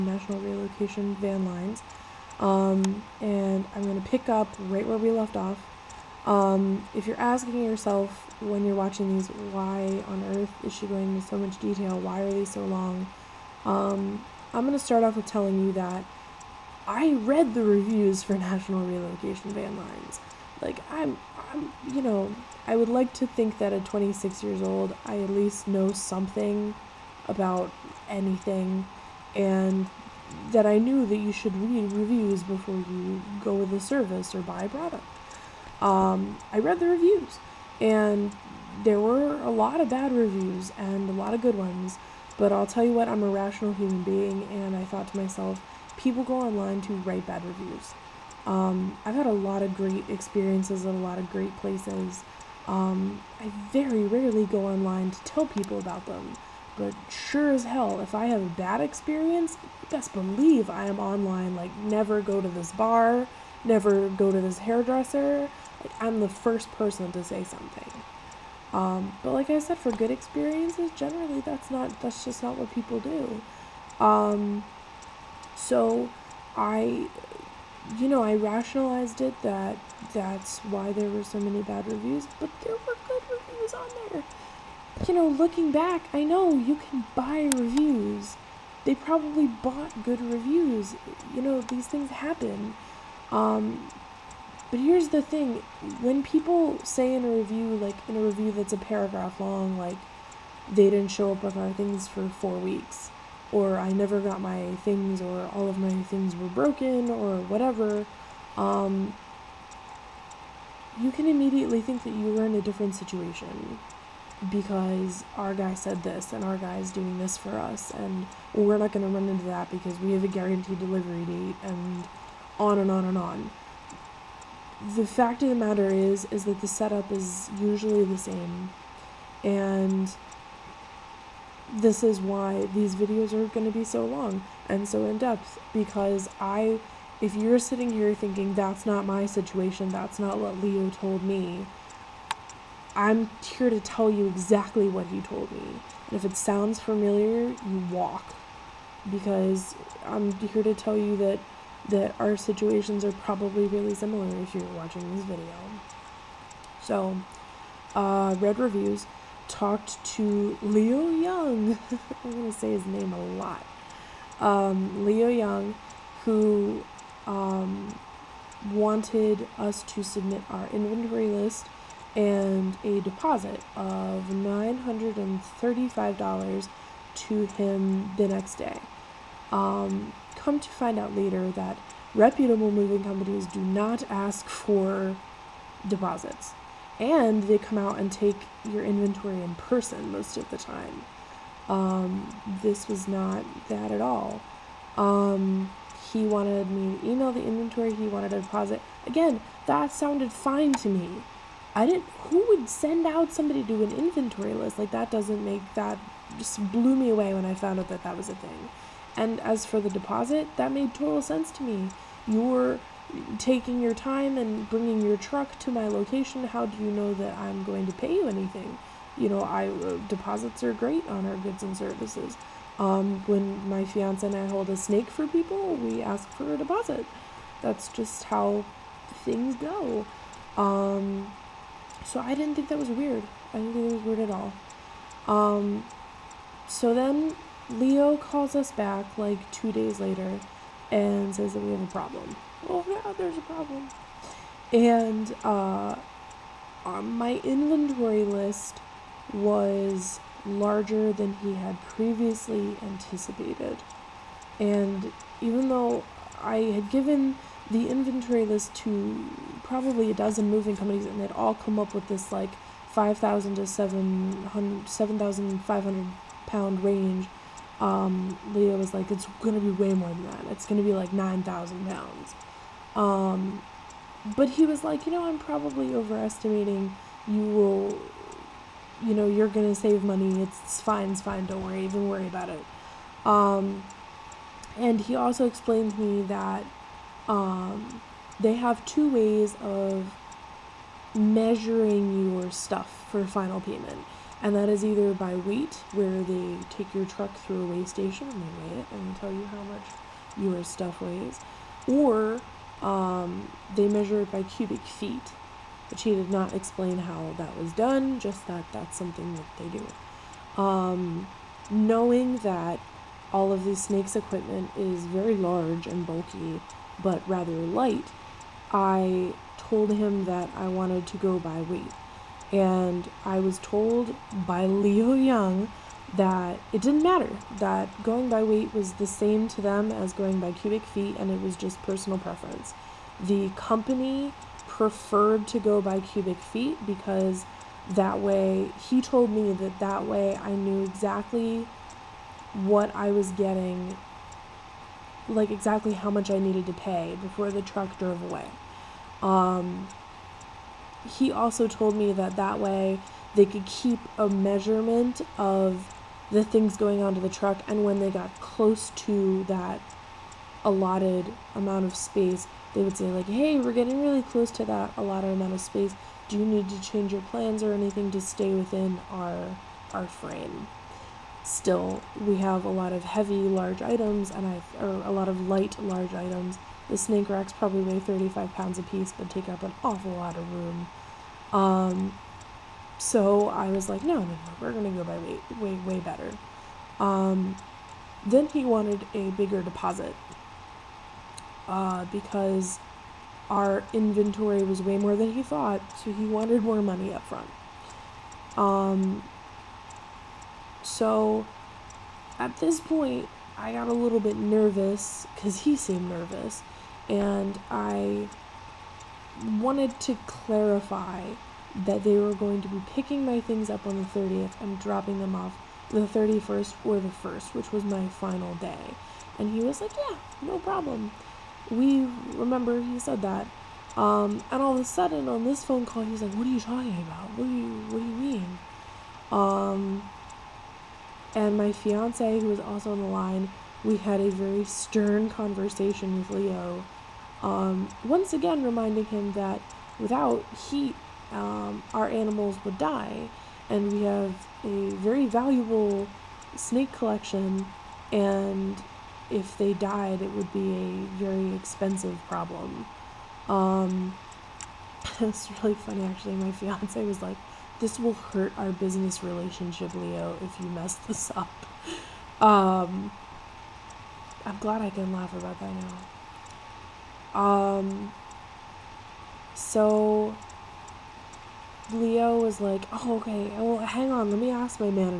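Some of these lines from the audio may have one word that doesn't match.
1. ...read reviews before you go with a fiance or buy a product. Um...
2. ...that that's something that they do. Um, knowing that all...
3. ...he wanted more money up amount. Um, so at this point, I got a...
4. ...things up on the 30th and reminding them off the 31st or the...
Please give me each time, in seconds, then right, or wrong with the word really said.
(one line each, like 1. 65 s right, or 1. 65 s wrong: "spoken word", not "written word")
1. 31 s wrong: "service", not "fiance"
2. 308 s right
3. 396 s wrong: "front", not "amount"
4. 413 s wrong: "dropping", not "reminding".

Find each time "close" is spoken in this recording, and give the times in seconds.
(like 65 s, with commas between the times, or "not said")
358 s, 364 s.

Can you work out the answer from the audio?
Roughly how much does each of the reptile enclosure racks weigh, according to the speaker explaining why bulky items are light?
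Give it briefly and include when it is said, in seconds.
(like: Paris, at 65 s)
35 pounds, at 377 s.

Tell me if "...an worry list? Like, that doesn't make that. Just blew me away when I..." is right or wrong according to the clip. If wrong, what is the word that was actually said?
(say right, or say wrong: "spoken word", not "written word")
wrong: "inventory", not "worry".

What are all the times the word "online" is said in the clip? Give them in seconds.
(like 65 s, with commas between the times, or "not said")
46 s, 54 s, 60 s.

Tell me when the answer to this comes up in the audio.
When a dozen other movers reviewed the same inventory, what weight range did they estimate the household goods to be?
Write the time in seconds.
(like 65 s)
262 s.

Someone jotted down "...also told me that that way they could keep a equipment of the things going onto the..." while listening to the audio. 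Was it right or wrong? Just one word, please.
wrong.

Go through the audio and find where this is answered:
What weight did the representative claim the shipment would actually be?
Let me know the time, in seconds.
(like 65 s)
271 s.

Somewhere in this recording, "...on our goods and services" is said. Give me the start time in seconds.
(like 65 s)
221 s.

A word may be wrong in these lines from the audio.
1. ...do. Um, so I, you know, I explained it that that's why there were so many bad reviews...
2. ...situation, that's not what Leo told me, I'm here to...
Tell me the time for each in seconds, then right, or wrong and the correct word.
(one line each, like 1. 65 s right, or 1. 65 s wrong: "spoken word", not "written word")
1. 72 s wrong: "rationalized", not "explained"
2. 139 s right.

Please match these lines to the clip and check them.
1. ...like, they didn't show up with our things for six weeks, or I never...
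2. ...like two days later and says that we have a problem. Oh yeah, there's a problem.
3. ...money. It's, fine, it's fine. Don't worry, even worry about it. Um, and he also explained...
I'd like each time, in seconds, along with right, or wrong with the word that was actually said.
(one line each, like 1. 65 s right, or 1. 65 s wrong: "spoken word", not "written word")
1. 99 s wrong: "four", not "six"
2. 239 s right
3. 280 s right.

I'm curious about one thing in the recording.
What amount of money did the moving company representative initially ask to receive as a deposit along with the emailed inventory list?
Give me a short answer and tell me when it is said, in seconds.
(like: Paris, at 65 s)
$935, at 174 s.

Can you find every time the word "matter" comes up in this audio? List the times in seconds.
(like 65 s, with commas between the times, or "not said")
125 s, 327 s.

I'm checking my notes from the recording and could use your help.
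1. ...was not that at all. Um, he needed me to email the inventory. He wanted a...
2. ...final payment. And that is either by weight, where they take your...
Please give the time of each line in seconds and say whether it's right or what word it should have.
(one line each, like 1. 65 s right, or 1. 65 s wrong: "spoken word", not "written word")
1. 192 s wrong: "wanted", not "needed"
2. 293 s right.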